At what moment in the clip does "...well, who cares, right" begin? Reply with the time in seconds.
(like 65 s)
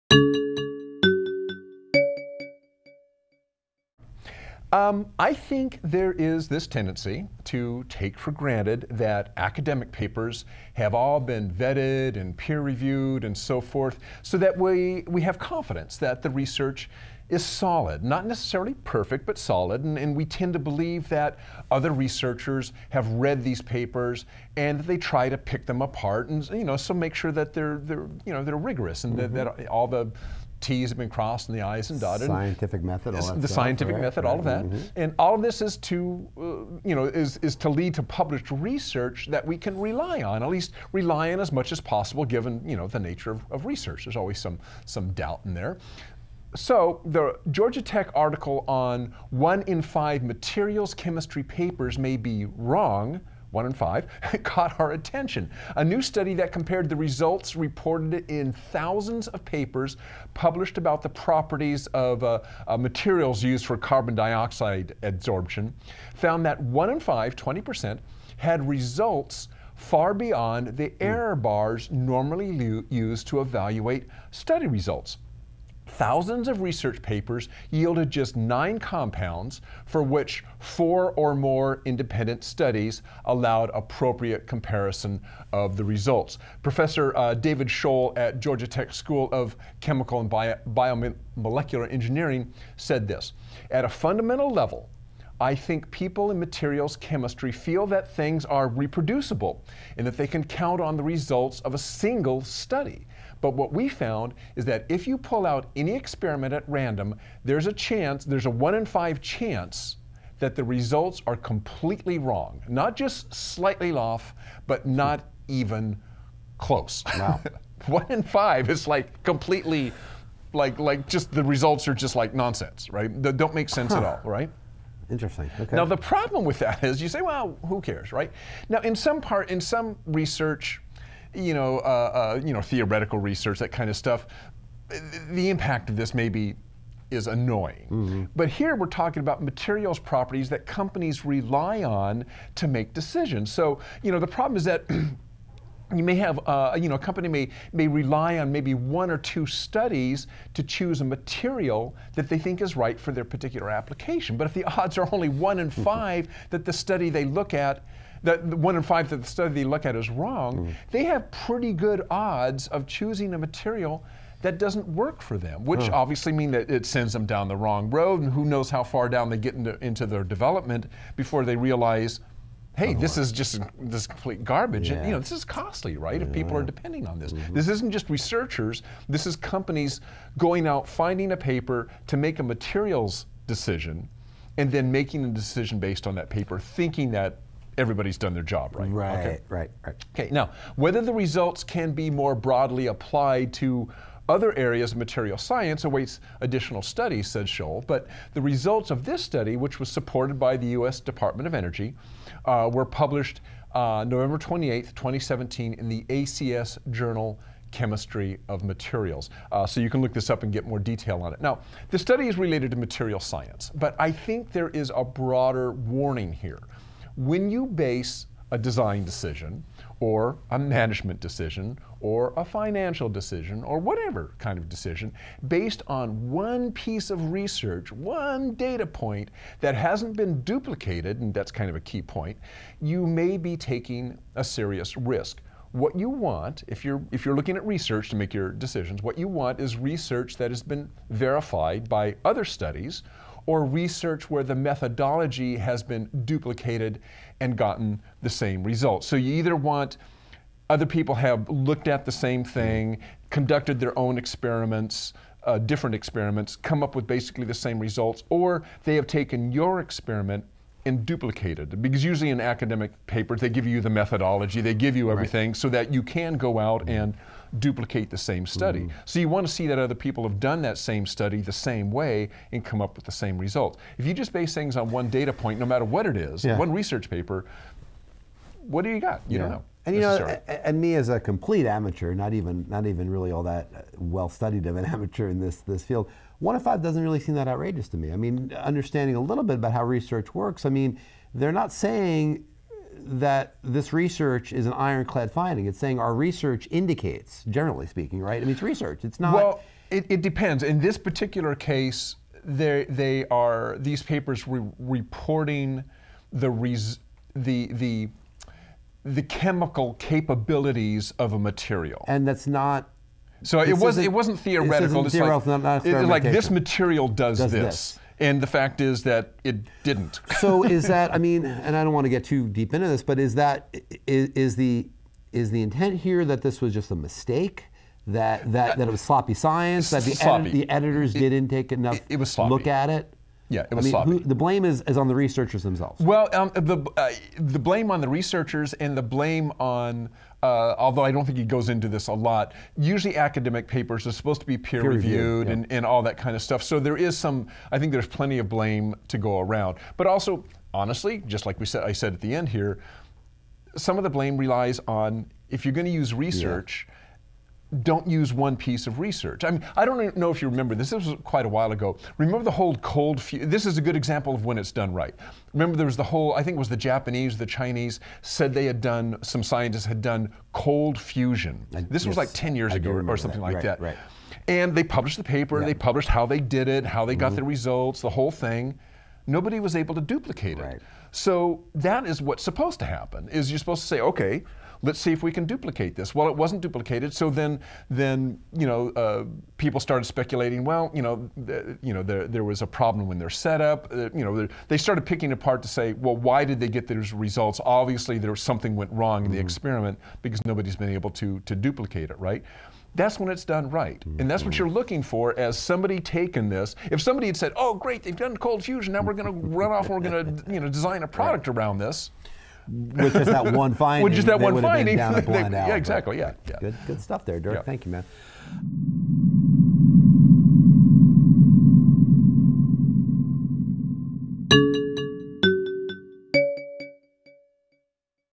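127 s.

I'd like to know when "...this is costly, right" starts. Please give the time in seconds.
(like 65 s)
175 s.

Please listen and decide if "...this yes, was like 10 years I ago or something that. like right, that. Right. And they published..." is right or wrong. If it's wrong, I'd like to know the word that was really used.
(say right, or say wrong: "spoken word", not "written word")
right.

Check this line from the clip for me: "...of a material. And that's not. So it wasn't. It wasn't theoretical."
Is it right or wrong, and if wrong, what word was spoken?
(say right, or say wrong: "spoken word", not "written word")
right.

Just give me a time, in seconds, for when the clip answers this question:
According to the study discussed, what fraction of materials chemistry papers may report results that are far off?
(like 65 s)
66 s.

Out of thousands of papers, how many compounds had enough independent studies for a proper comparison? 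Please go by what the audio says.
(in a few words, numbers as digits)
9.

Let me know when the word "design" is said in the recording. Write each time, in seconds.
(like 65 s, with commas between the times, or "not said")
218 s, 410 s.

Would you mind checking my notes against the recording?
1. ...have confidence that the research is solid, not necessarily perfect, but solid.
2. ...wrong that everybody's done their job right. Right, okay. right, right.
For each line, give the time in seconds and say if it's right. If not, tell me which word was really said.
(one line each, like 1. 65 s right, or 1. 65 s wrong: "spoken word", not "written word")
1. 15 s right
2. 186 s wrong: "thinking", not "wrong".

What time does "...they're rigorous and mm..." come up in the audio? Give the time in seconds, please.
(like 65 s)
28 s.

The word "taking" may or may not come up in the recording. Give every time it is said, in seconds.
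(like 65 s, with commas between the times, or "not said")
233 s, 406 s.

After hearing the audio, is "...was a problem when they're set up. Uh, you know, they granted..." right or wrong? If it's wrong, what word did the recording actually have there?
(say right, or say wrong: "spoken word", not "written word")
wrong: "started", not "granted".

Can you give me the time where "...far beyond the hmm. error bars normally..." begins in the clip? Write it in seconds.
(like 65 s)
69 s.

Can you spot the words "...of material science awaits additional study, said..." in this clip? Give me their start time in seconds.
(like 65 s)
194 s.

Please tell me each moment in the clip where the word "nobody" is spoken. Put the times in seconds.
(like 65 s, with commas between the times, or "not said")
379 s, 400 s.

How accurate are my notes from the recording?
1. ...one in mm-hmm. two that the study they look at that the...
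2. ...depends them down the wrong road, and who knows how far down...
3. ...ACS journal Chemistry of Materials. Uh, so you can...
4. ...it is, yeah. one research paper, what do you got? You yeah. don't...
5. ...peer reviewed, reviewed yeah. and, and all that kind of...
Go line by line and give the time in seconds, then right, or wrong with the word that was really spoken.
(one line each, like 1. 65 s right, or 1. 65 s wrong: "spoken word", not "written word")
1. 155 s wrong: "five", not "two"
2. 166 s wrong: "sends", not "depends"
3. 206 s right
4. 276 s right
5. 344 s right.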